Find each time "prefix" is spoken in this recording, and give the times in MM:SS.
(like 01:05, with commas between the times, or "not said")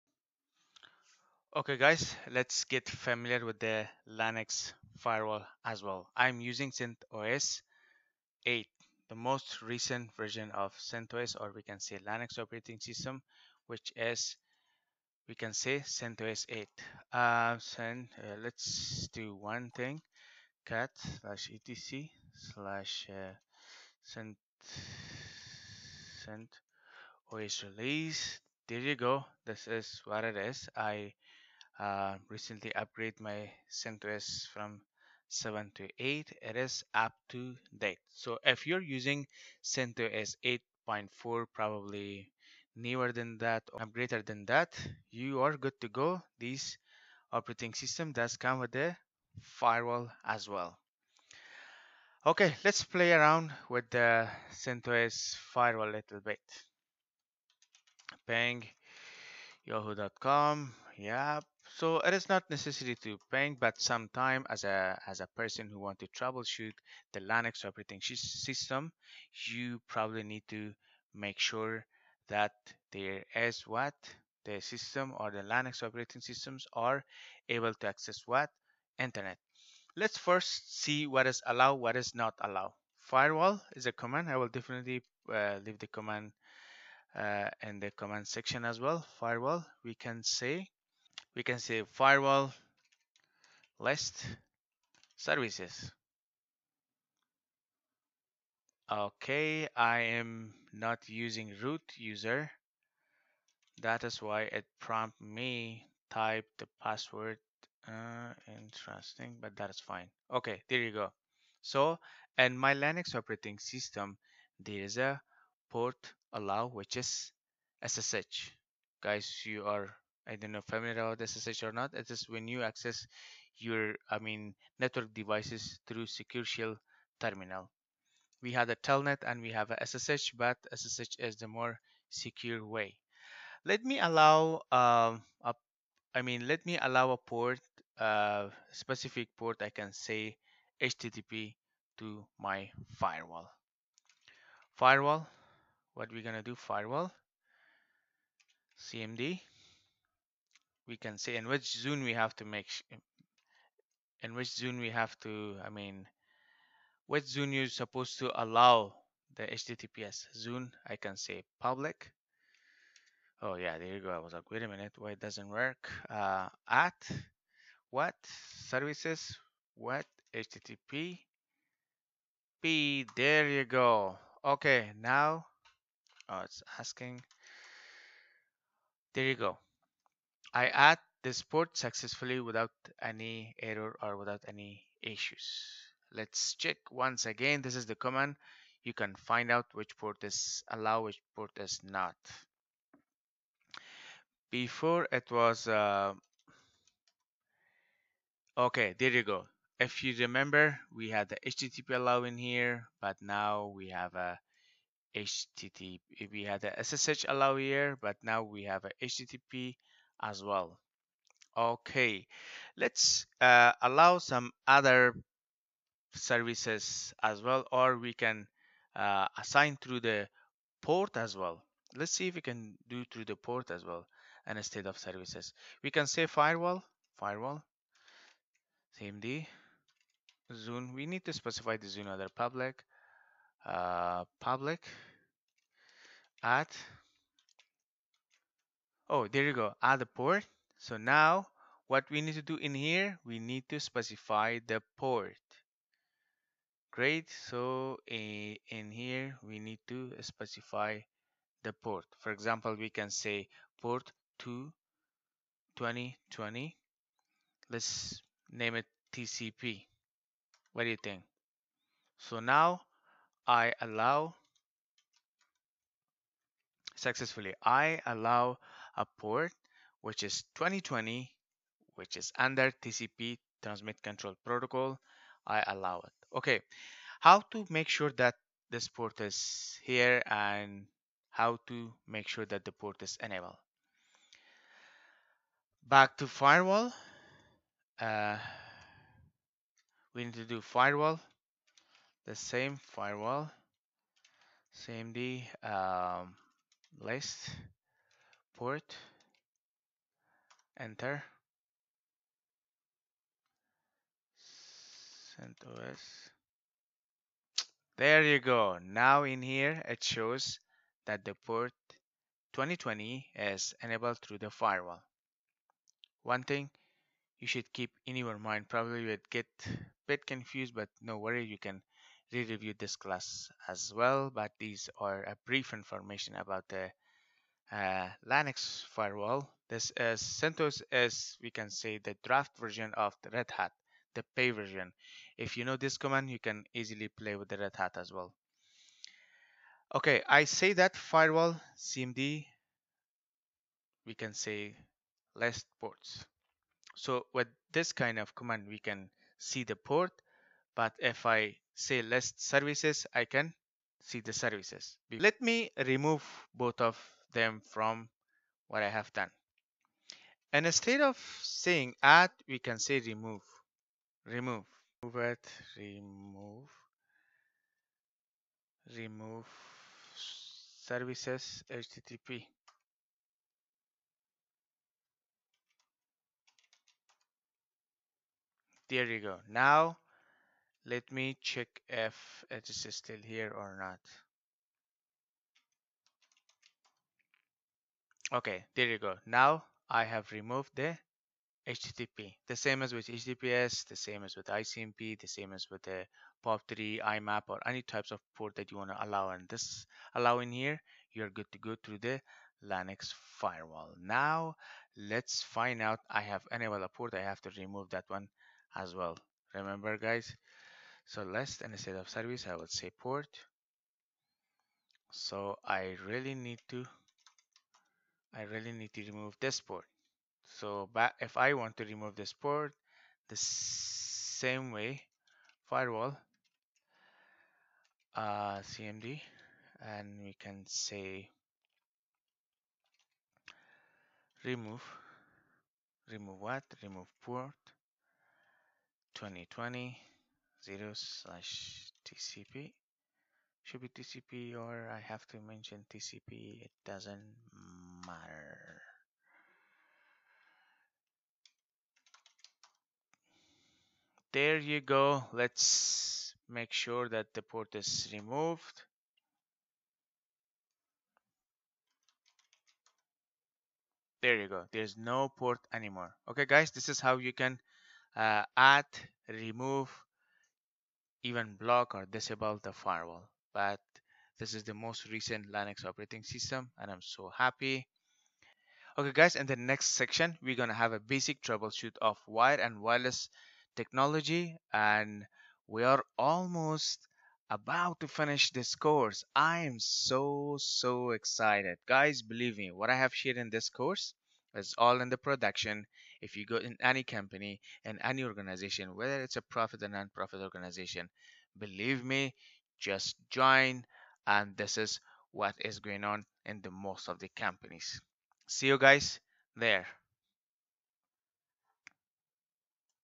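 not said.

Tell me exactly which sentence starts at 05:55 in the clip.
Let me remove both of them from what I have done.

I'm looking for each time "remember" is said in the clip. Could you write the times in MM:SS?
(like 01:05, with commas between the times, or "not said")
03:20, 06:49.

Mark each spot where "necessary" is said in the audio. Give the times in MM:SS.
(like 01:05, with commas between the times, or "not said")
01:02.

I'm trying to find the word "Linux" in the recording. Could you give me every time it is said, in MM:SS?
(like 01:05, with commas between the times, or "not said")
00:04, 00:12, 01:07, 01:15, 01:52, 05:28, 06:42, 07:55.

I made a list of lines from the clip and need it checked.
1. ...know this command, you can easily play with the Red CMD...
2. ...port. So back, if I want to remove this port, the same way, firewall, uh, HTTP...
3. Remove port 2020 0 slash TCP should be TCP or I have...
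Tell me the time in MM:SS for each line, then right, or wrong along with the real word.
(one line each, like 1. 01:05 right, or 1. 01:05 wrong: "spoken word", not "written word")
1. 05:35 wrong: "Hat", not "CMD"
2. 06:59 wrong: "CMD", not "HTTP"
3. 07:16 right.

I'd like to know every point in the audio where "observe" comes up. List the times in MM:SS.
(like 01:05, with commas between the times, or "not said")
not said.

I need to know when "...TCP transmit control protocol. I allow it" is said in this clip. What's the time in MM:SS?
04:32.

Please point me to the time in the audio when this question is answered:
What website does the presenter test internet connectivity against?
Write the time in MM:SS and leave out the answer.
00:59.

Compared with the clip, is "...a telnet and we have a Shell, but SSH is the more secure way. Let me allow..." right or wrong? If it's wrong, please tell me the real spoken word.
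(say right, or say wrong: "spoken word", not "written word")
wrong: "SSH", not "Shell".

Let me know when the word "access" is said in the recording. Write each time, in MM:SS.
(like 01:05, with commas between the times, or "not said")
01:17, 02:02.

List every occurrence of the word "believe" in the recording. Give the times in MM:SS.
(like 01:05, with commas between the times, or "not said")
08:12, 08:21.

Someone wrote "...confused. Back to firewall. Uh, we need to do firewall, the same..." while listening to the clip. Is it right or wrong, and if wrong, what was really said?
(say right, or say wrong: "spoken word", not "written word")
wrong: "enabled", not "confused".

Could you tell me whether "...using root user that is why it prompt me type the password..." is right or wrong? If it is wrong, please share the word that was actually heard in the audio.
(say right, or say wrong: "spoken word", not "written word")
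right.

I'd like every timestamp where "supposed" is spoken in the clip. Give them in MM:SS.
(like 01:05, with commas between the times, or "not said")
02:37.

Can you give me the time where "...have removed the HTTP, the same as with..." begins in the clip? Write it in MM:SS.
06:30.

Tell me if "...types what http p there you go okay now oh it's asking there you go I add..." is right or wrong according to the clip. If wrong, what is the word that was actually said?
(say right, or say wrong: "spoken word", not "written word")
wrong: "services", not "types".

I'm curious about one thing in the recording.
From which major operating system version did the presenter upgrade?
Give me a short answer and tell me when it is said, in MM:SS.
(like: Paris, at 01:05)
7, at 00:34.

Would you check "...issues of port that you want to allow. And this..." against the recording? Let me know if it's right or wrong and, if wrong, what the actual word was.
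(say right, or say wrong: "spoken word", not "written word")
wrong: "types", not "issues".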